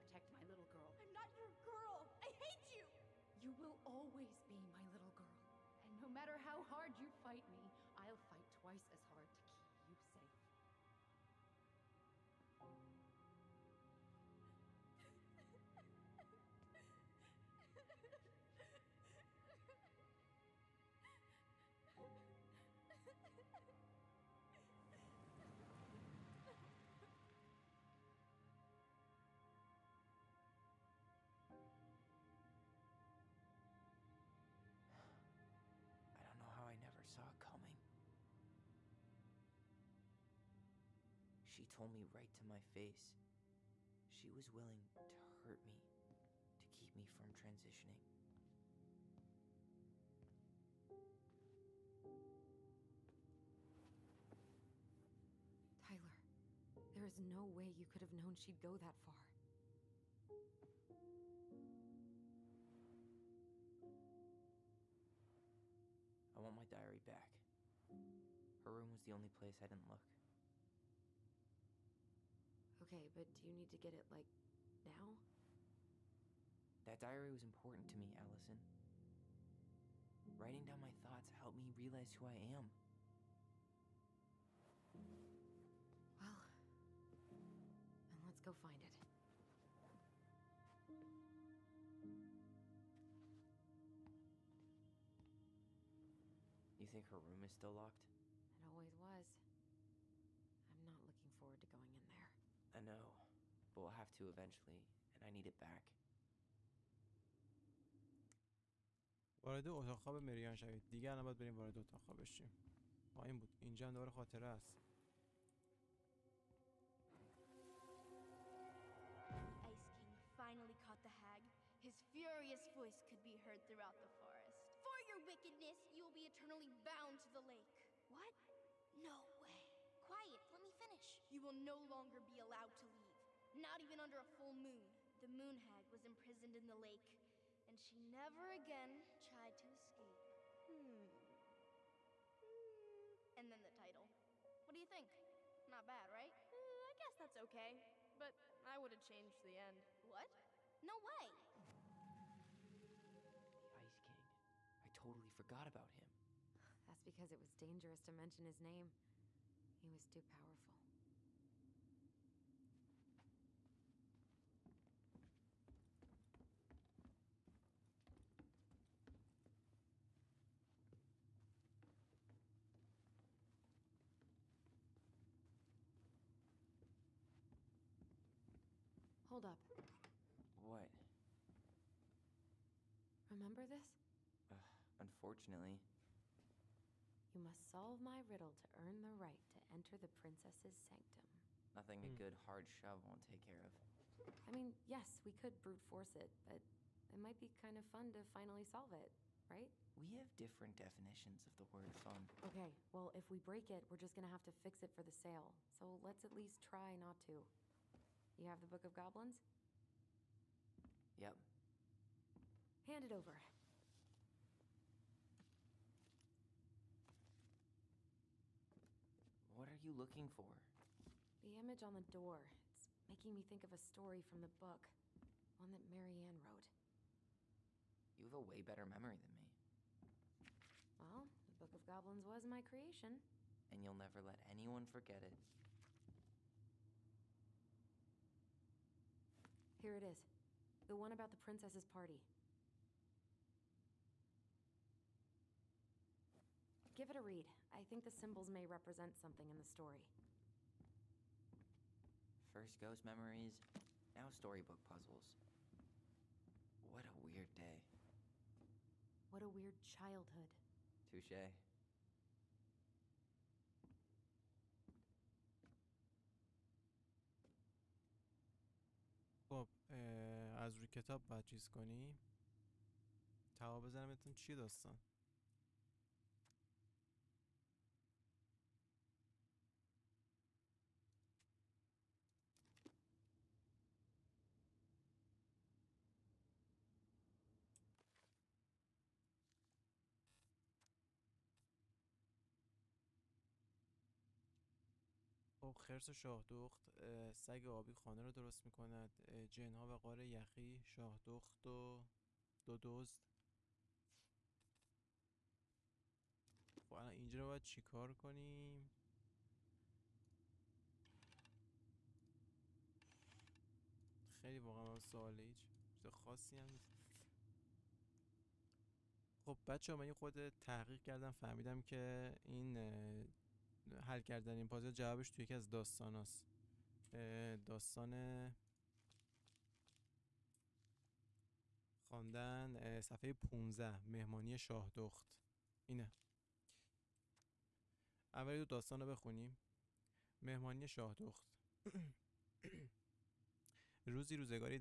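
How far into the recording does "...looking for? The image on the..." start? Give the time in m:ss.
3:39.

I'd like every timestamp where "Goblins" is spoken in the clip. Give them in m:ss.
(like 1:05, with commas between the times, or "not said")
3:28, 3:51.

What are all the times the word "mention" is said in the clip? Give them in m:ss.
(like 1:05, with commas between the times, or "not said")
2:38.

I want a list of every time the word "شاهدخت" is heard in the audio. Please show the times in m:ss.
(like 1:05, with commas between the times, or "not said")
4:56, 5:00.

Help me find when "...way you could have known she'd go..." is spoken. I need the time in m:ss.
0:57.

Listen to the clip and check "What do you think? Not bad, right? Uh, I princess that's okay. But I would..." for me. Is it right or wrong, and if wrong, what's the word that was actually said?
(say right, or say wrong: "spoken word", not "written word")
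wrong: "guess", not "princess".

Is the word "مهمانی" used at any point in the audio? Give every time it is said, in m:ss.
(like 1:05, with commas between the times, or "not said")
5:34, 5:40.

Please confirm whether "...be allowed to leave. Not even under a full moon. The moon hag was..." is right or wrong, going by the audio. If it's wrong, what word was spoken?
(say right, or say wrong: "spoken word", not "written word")
right.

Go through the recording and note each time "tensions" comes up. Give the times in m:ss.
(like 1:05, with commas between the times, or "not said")
not said.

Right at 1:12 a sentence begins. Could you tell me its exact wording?
Okay, but do you need to get it, like, now?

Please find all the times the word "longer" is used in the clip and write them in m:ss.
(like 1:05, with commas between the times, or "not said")
2:11.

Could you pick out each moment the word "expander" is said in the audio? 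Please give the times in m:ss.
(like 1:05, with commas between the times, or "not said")
not said.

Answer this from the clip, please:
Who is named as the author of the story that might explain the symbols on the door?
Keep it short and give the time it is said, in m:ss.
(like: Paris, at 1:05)
Mary-Ann, at 3:45.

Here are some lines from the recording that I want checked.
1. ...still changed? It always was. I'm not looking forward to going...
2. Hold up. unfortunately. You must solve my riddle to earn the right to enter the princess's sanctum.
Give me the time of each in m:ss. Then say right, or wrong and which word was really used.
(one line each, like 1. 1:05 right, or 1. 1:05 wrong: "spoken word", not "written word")
1. 1:37 wrong: "locked", not "changed"
2. 2:59 right.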